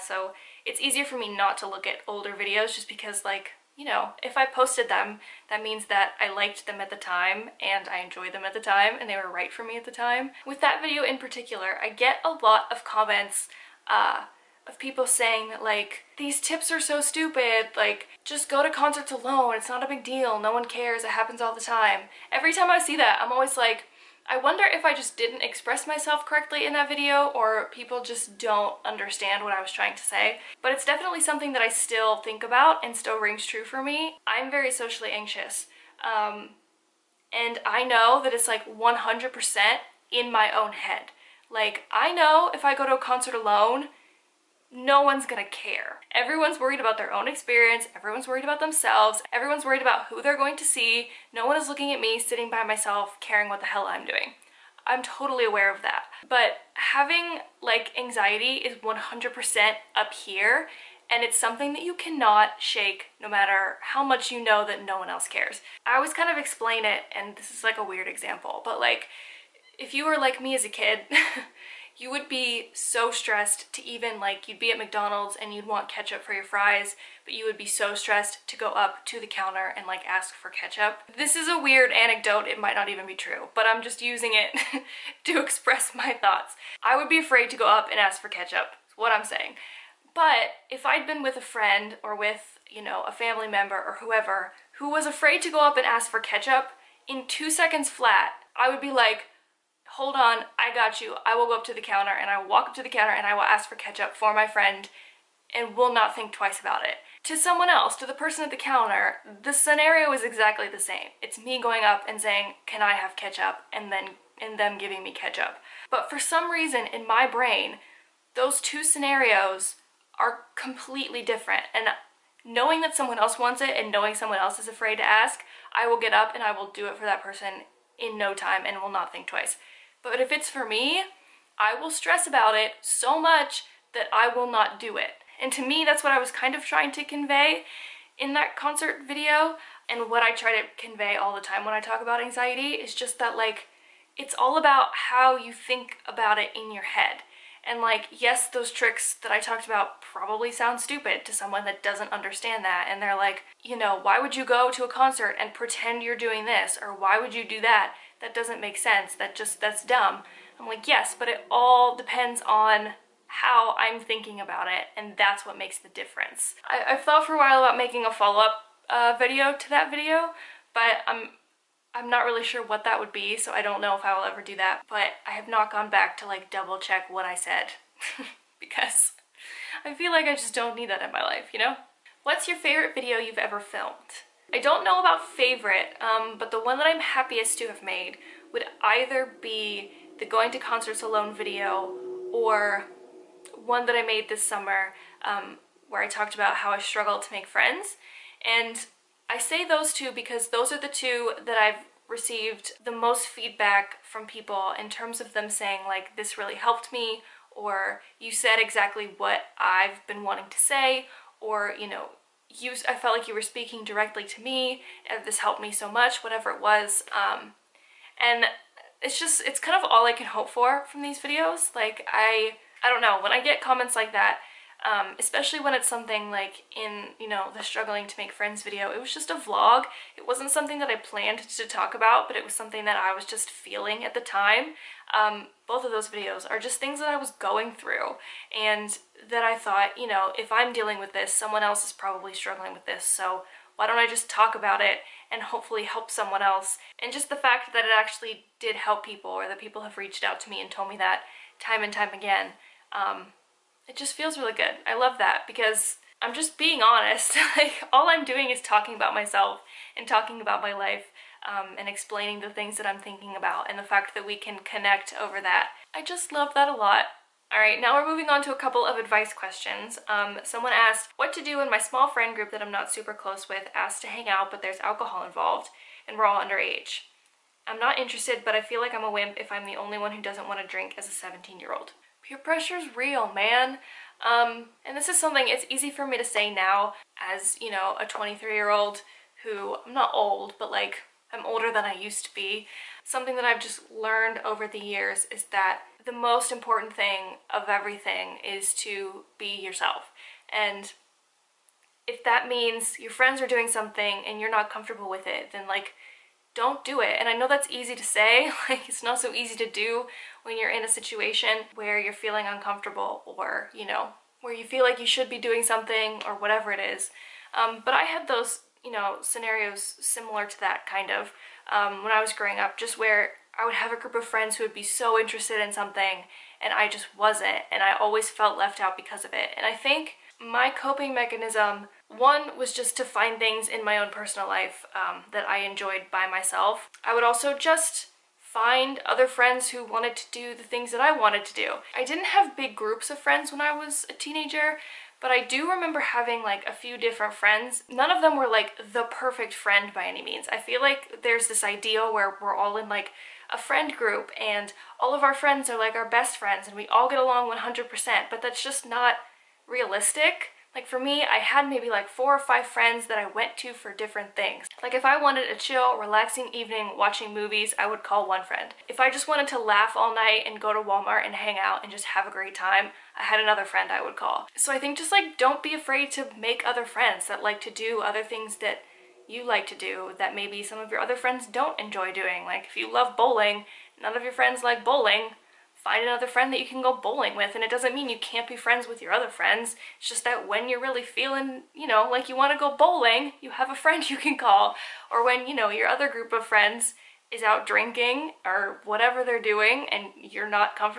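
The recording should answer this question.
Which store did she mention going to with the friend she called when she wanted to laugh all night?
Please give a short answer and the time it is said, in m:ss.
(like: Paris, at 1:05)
Walmart, at 6:10.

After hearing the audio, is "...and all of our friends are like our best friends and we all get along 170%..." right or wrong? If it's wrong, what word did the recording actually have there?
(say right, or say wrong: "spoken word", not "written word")
wrong: "100", not "170".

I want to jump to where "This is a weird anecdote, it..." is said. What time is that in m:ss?
1:21.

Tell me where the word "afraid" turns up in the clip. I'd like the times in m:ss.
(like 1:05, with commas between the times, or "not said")
1:27, 1:35, 2:04, 6:15.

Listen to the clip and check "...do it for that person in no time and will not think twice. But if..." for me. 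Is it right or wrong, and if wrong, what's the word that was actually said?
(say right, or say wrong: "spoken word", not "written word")
right.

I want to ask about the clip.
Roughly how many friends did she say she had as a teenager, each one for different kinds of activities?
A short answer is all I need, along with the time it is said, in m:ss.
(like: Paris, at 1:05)
4 or 5, at 6:02.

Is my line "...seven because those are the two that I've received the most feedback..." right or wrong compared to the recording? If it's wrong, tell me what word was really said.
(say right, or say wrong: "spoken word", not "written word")
wrong: "two", not "seven".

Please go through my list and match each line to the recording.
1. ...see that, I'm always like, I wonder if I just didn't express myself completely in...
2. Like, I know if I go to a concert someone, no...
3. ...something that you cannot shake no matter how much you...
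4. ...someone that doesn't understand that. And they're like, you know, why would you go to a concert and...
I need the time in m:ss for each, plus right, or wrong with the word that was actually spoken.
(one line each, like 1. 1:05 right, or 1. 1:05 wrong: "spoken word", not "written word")
1. 0:22 wrong: "correctly", not "completely"
2. 0:41 wrong: "alone", not "someone"
3. 1:01 right
4. 2:31 right.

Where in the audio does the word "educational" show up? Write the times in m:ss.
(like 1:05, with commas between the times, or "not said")
not said.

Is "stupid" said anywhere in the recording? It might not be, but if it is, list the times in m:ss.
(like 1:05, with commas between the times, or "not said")
0:16, 2:30.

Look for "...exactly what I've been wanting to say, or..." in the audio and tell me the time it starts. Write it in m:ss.
3:28.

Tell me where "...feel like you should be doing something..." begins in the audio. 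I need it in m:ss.
5:14.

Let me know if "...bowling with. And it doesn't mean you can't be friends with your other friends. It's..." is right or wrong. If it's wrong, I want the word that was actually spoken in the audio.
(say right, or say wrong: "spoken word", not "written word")
right.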